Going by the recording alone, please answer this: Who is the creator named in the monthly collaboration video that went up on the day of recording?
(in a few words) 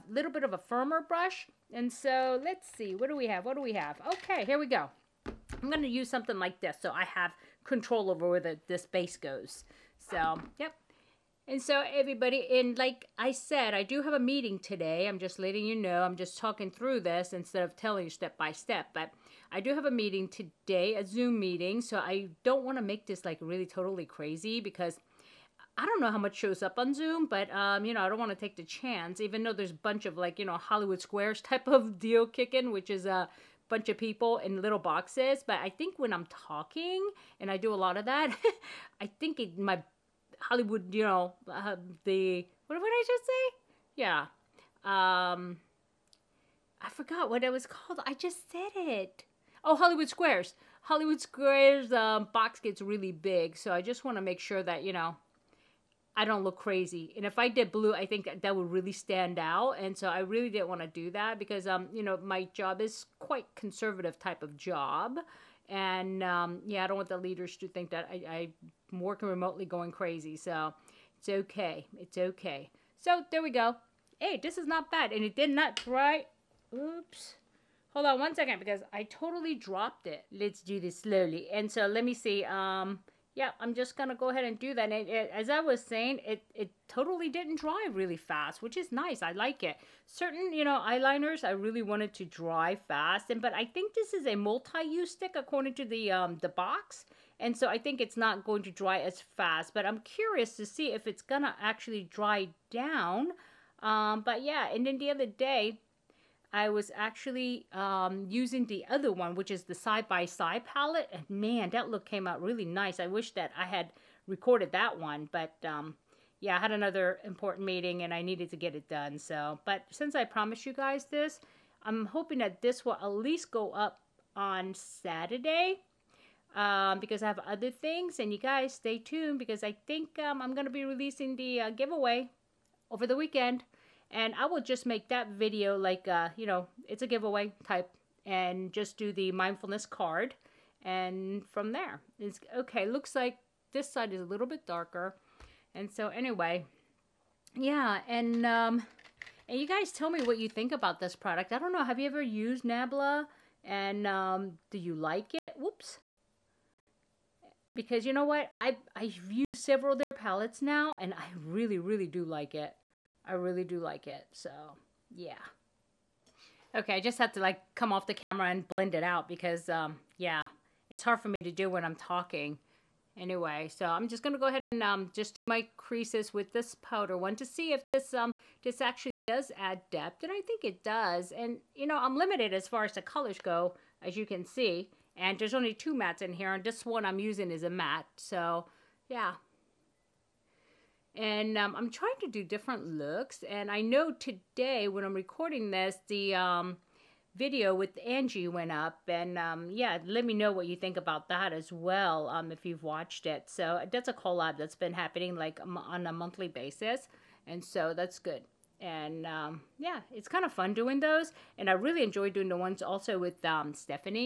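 Angie.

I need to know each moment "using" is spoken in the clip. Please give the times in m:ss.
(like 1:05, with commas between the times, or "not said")
1:48, 3:07.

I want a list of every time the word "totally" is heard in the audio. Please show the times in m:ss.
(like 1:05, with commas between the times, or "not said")
0:23, 1:19, 1:26.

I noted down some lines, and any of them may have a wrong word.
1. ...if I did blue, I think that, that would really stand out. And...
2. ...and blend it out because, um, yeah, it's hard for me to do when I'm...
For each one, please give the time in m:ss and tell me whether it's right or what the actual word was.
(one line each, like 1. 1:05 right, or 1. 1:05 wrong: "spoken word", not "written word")
1. 0:57 right
2. 2:48 right.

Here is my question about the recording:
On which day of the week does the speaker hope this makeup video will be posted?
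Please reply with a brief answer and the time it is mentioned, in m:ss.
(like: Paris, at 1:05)
Saturday, at 2:04.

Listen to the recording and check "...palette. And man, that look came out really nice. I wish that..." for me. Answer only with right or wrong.
right.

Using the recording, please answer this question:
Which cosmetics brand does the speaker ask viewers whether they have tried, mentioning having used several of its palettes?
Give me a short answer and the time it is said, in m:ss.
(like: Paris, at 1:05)
Nabla, at 2:32.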